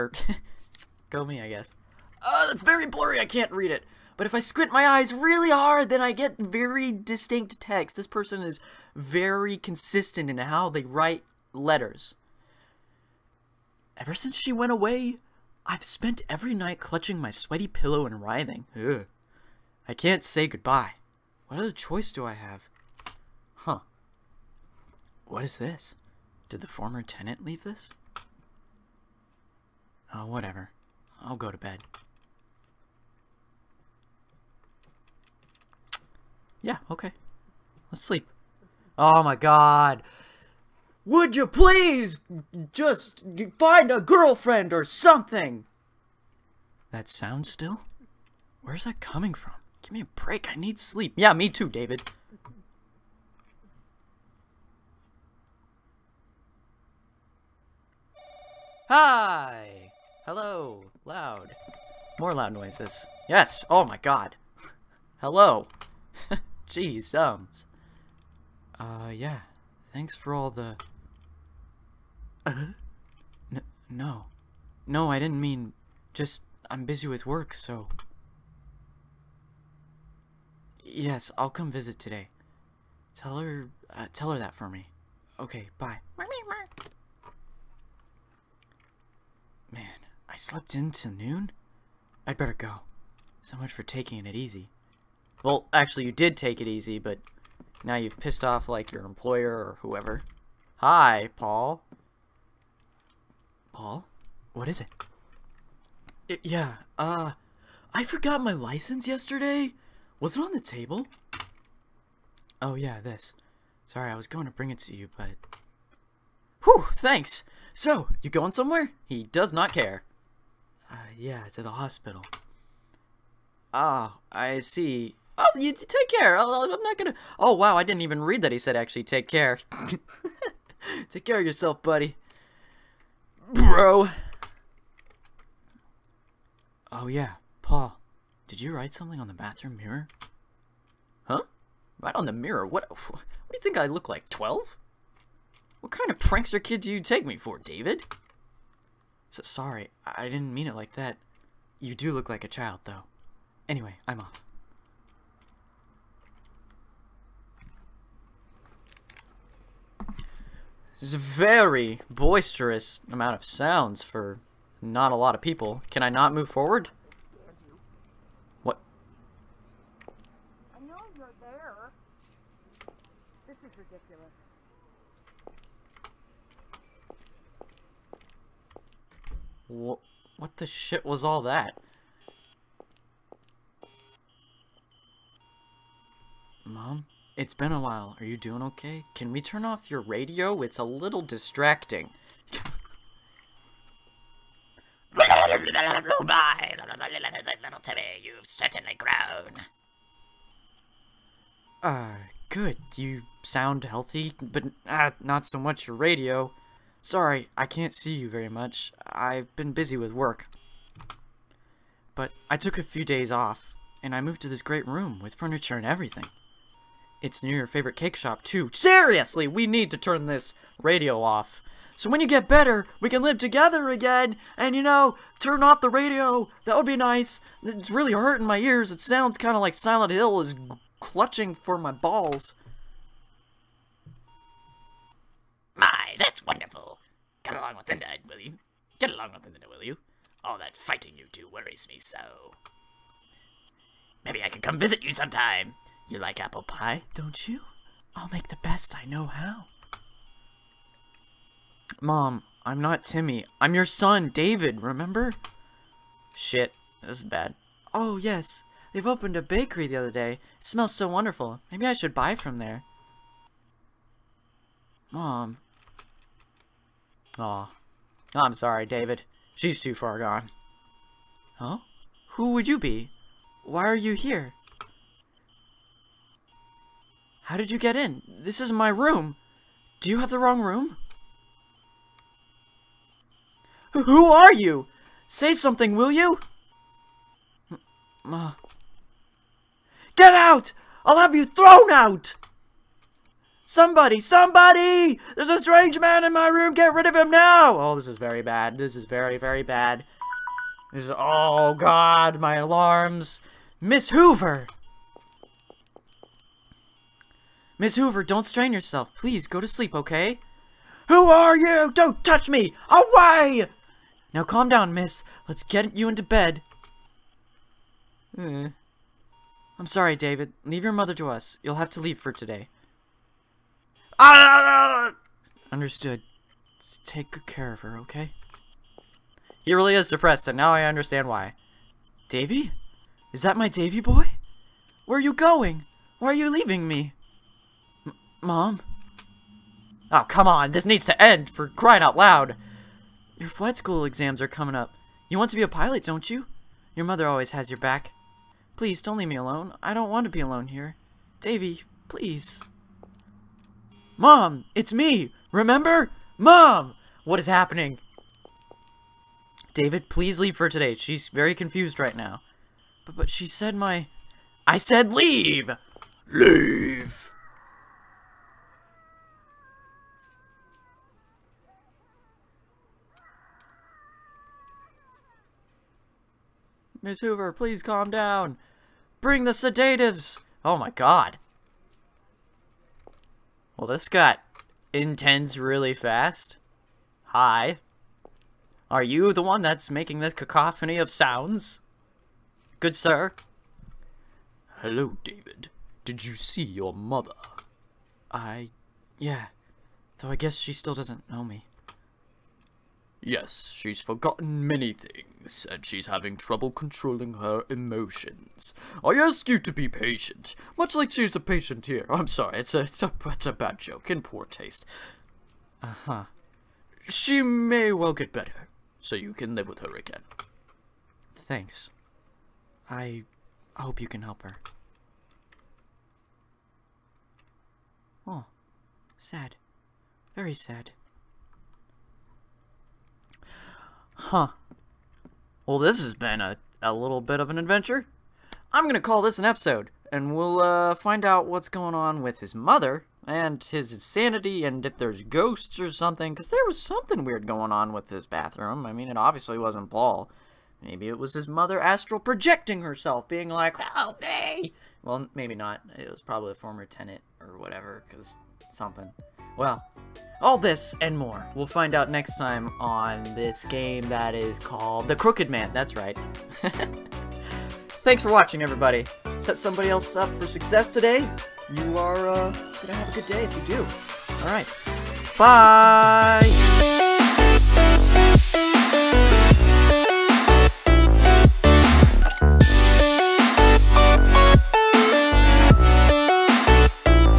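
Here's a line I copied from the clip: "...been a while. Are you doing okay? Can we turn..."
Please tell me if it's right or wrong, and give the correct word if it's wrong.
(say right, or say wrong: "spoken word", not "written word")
right.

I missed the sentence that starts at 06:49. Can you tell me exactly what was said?
I ask you to be patient, much like she's a patient here.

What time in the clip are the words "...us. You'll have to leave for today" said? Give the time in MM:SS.
05:21.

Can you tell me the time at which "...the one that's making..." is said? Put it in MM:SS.
06:29.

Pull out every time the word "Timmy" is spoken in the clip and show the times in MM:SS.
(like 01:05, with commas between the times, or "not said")
03:17, 04:13.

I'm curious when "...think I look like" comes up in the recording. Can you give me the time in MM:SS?
02:23.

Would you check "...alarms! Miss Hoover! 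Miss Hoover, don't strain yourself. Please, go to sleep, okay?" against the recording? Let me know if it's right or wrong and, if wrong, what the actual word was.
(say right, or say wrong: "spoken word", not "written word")
right.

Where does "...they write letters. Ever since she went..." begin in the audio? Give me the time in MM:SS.
00:10.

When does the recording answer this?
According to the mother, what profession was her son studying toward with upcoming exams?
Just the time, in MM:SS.
05:45.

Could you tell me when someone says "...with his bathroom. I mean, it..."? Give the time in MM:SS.
07:27.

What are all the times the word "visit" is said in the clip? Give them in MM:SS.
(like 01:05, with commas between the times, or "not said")
01:21, 04:04.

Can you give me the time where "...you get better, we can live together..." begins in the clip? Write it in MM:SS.
03:42.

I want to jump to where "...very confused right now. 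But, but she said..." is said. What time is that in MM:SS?
06:01.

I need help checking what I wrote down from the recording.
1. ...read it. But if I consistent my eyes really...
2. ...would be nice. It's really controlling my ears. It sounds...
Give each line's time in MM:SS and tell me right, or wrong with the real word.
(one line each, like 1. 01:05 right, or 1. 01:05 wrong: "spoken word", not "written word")
1. 00:03 wrong: "squint", not "consistent"
2. 03:46 wrong: "hurting", not "controlling".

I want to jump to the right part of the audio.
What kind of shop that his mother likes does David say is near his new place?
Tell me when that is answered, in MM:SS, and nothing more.
03:37.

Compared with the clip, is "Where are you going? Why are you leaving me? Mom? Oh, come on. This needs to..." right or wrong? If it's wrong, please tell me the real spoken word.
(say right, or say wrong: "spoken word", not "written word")
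right.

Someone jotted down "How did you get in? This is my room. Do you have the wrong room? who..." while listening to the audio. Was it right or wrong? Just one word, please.
right.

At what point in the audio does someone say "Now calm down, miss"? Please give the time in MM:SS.
05:14.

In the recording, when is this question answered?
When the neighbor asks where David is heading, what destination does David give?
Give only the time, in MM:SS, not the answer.
02:01.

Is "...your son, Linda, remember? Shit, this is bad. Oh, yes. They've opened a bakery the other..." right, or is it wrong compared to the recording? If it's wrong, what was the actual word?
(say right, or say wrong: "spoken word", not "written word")
wrong: "David", not "Linda".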